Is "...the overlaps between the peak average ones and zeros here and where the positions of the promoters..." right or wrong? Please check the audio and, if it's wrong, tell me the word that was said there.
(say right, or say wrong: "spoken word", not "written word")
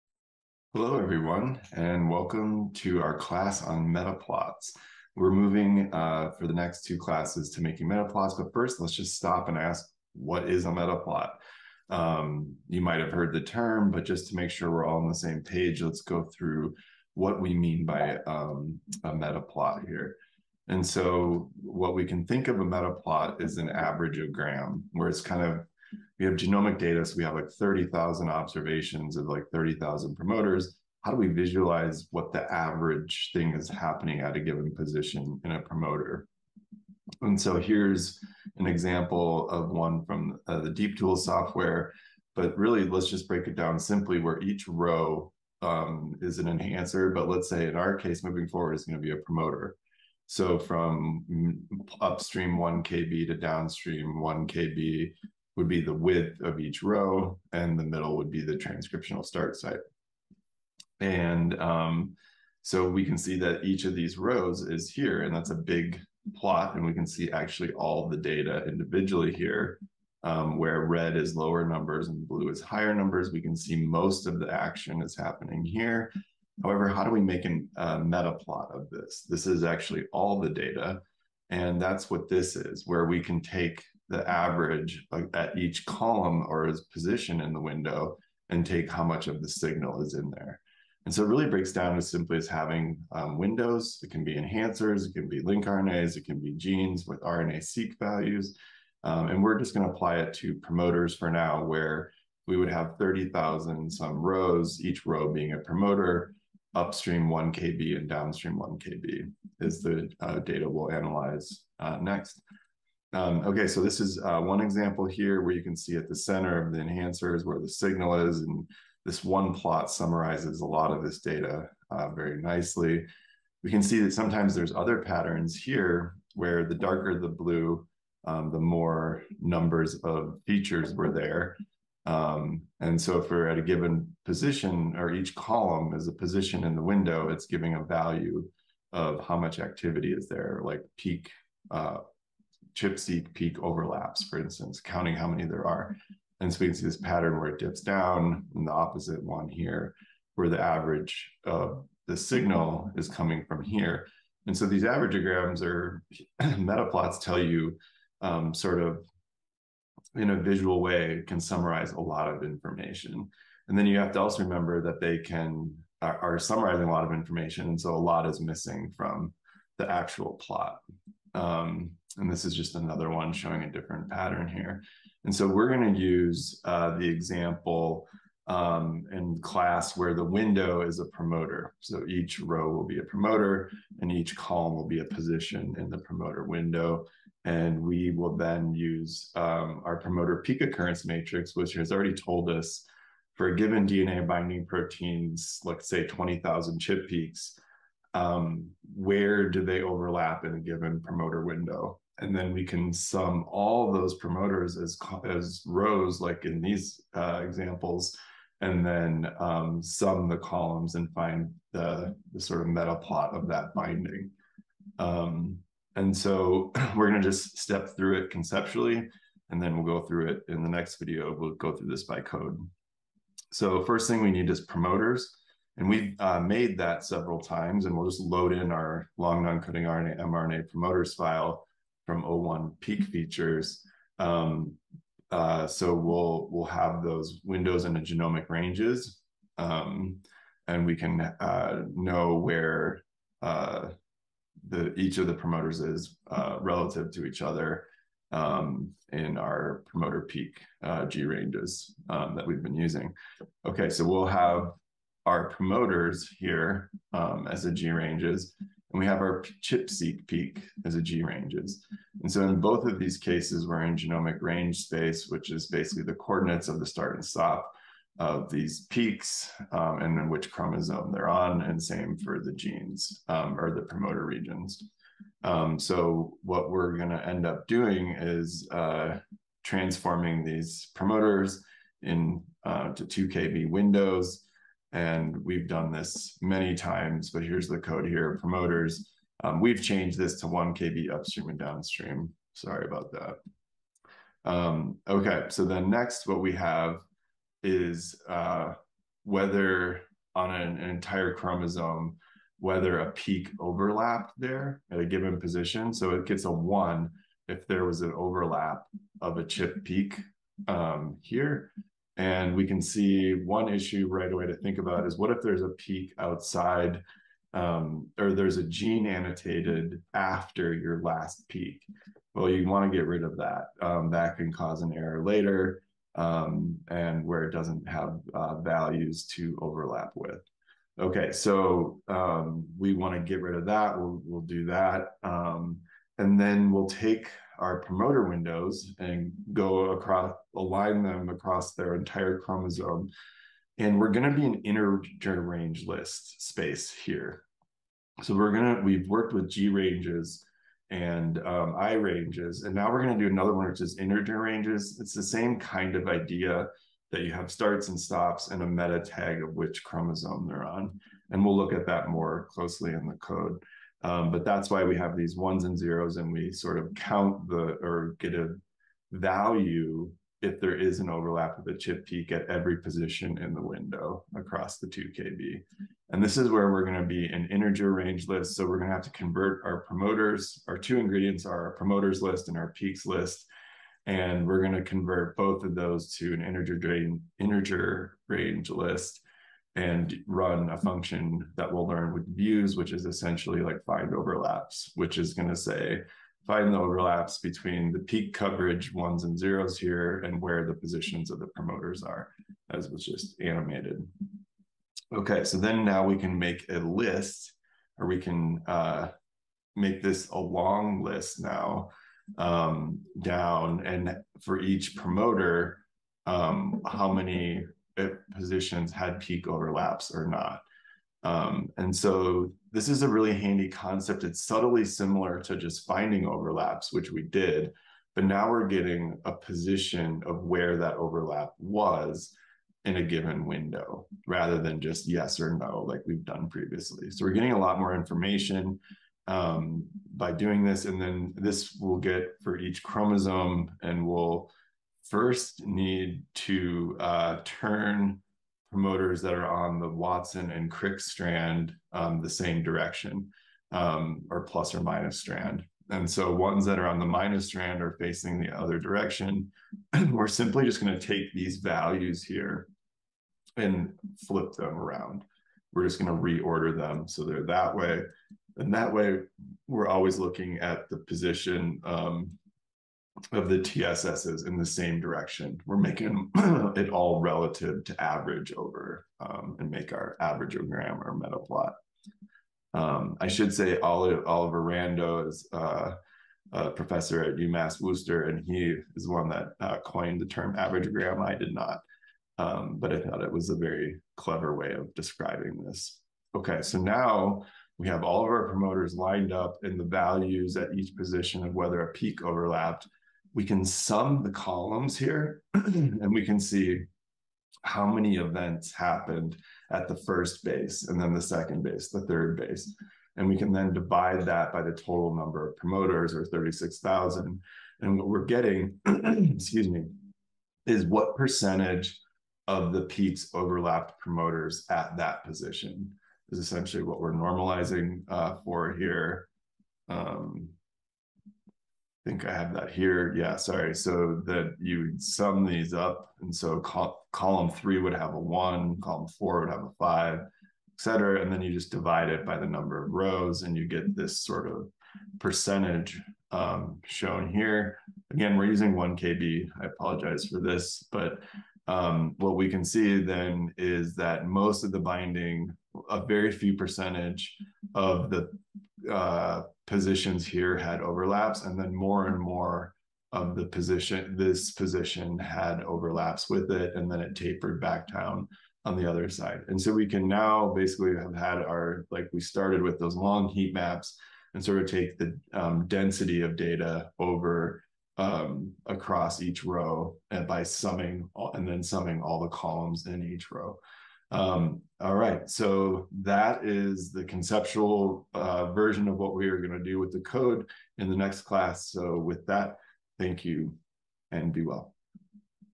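wrong: "coverage", not "average".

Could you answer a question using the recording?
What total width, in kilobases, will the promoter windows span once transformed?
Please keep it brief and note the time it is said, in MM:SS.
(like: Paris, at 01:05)
2 kb, at 04:42.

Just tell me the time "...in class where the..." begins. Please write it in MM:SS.
02:59.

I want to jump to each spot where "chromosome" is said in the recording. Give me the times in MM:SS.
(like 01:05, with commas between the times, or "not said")
04:30, 05:01, 05:42, 05:59, 07:22.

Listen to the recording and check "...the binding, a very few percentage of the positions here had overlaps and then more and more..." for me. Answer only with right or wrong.
right.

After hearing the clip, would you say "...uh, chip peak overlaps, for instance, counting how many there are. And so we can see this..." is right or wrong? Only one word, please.
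right.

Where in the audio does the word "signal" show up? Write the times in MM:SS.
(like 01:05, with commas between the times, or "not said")
01:29, 01:57, 02:32.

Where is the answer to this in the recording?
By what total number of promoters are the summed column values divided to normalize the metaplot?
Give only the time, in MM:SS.
08:36.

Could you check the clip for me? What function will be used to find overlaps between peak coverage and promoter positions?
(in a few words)
Views.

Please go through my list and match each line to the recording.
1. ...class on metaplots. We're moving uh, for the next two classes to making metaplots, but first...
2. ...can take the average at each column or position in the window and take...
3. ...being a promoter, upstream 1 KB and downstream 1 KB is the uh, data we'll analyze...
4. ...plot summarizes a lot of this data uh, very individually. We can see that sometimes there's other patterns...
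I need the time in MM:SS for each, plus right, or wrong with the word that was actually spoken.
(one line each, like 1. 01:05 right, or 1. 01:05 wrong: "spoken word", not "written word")
1. 00:03 right
2. 01:23 right
3. 01:45 right
4. 01:59 wrong: "nicely", not "individually".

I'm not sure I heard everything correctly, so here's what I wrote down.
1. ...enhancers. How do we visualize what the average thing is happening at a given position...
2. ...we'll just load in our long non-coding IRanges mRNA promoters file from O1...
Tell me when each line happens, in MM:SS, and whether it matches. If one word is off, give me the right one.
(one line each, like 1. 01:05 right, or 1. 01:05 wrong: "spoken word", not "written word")
1. 00:30 wrong: "promoters", not "enhancers"
2. 03:47 wrong: "RNA", not "IRanges".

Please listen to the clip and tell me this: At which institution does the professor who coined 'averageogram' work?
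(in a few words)
UMass Worcester.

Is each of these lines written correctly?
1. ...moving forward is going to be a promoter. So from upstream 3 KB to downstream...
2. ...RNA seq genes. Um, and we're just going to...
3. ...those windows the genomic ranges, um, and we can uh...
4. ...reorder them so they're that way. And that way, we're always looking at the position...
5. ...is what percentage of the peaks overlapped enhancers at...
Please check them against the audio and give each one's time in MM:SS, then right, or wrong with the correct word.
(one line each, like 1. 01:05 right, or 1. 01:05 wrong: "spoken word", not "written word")
1. 00:48 wrong: "1", not "3"
2. 01:37 wrong: "values", not "genes"
3. 03:57 right
4. 07:46 right
5. 08:40 wrong: "promoters", not "enhancers".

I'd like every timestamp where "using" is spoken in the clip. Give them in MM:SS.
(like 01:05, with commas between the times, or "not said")
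04:12, 09:08.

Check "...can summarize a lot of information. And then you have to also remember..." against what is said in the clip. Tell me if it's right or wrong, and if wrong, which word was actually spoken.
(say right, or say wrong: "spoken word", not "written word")
right.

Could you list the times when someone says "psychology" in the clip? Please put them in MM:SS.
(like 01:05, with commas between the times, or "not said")
not said.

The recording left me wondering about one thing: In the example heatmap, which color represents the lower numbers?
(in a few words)
Red.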